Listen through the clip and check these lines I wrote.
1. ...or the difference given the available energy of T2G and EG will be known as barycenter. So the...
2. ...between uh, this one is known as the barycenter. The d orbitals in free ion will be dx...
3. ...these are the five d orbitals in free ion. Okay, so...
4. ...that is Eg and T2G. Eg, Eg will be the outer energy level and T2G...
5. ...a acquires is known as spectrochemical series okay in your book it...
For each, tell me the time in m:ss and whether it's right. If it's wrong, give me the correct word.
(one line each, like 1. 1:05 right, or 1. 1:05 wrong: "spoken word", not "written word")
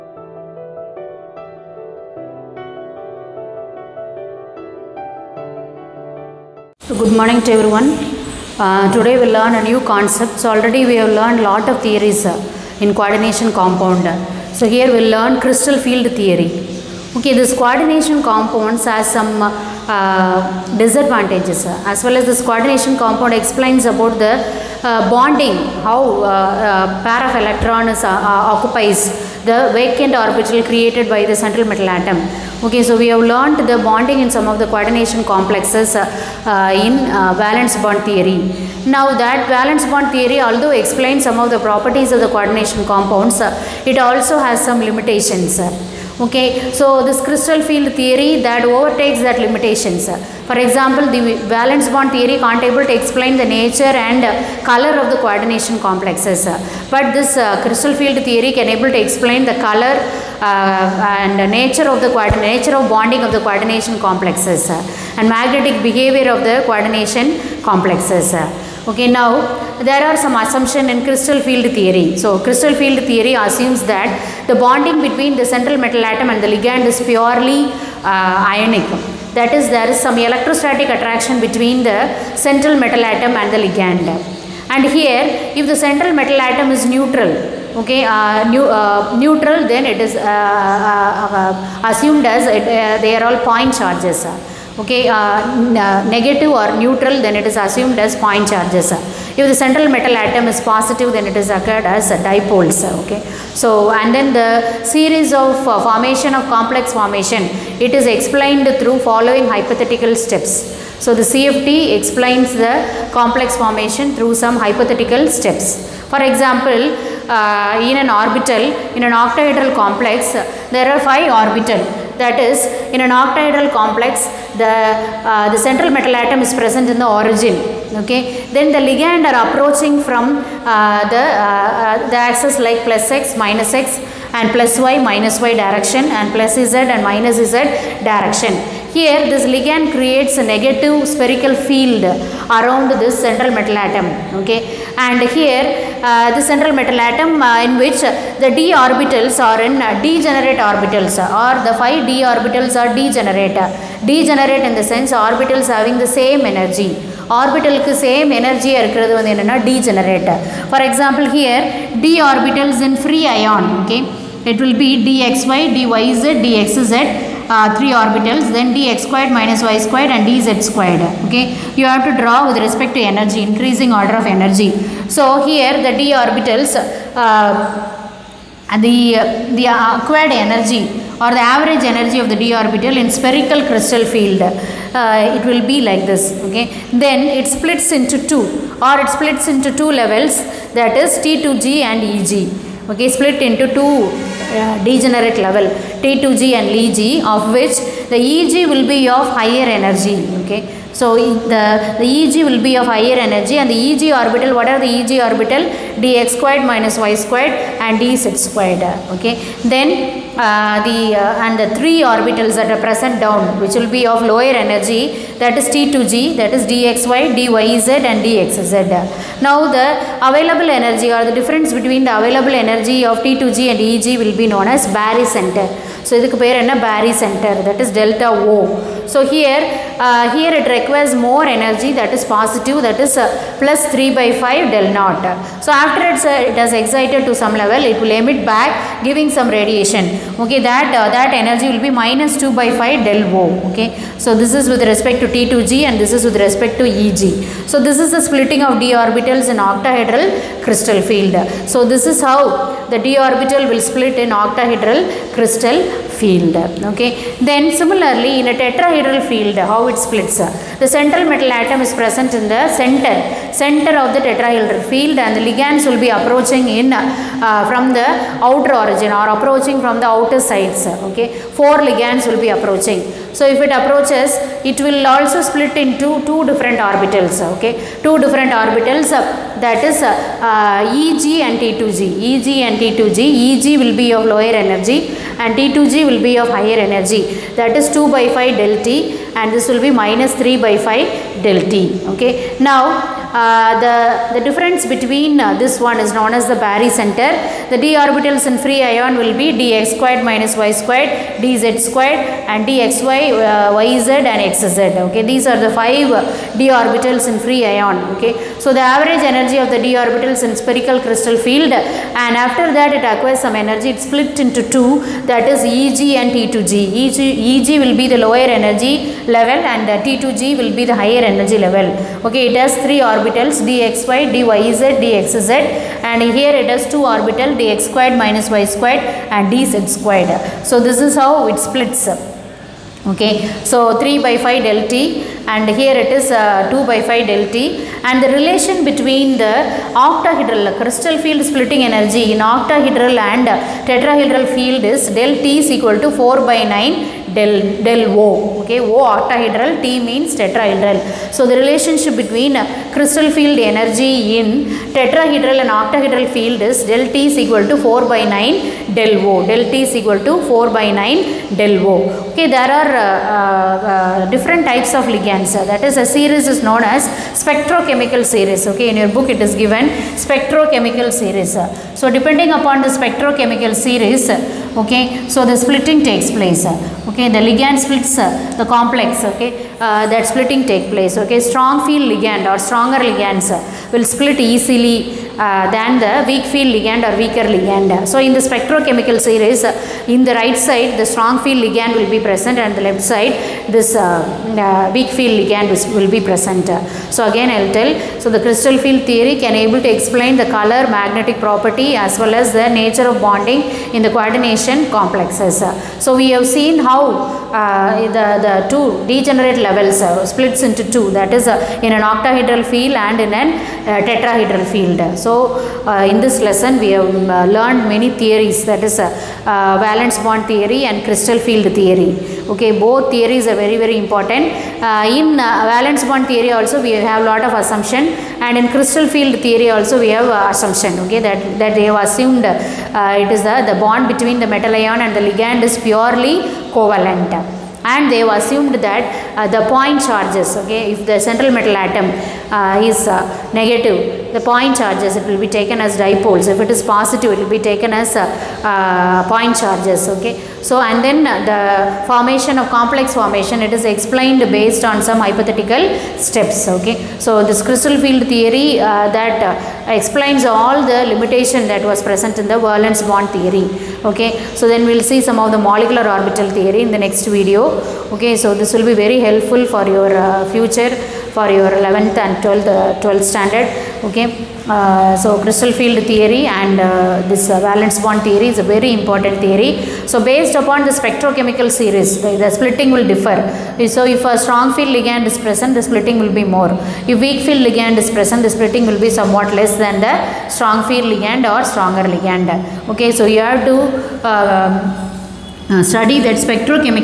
1. 3:41 wrong: "between", not "given"
2. 4:54 right
3. 5:05 right
4. 5:15 wrong: "lower", not "outer"
5. 6:06 wrong: "series", not "acquires".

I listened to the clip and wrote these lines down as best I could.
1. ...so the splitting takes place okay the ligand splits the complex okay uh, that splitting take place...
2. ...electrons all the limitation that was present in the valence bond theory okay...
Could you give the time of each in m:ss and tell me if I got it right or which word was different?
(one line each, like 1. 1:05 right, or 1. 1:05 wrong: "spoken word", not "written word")
1. 6:15 right
2. 7:39 wrong: "explains", not "electrons".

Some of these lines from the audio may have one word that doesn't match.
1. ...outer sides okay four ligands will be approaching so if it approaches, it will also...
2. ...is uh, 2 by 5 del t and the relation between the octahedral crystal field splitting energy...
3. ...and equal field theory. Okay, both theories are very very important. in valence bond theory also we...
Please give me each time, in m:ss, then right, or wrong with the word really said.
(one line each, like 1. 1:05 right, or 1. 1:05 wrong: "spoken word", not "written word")
1. 4:30 right
2. 5:36 right
3. 7:00 wrong: "crystal", not "equal".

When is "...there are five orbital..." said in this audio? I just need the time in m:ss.
2:00.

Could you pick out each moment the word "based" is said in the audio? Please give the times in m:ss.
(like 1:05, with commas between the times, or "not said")
7:34, 8:00.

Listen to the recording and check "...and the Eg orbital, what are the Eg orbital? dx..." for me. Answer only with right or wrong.
right.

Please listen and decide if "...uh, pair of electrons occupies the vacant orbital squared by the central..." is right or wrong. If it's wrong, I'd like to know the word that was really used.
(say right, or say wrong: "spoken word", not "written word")
wrong: "created", not "squared".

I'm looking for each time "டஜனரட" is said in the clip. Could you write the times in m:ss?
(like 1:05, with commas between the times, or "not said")
2:39.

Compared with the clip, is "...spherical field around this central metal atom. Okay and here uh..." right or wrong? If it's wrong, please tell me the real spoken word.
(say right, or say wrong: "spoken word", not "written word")
right.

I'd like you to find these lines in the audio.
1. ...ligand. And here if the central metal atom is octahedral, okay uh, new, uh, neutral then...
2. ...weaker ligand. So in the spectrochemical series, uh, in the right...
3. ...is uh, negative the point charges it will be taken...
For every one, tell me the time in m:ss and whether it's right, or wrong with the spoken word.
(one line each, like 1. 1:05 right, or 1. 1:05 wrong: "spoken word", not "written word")
1. 1:23 wrong: "neutral", not "octahedral"
2. 6:27 right
3. 7:22 right.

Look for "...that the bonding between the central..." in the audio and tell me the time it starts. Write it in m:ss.
1:13.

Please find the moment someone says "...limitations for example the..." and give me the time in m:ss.
0:49.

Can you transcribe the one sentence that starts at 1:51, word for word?
So, the CFT explains the complex formation through some hypothetical steps.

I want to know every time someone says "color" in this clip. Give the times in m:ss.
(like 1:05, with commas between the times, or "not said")
0:54, 0:59, 6:40.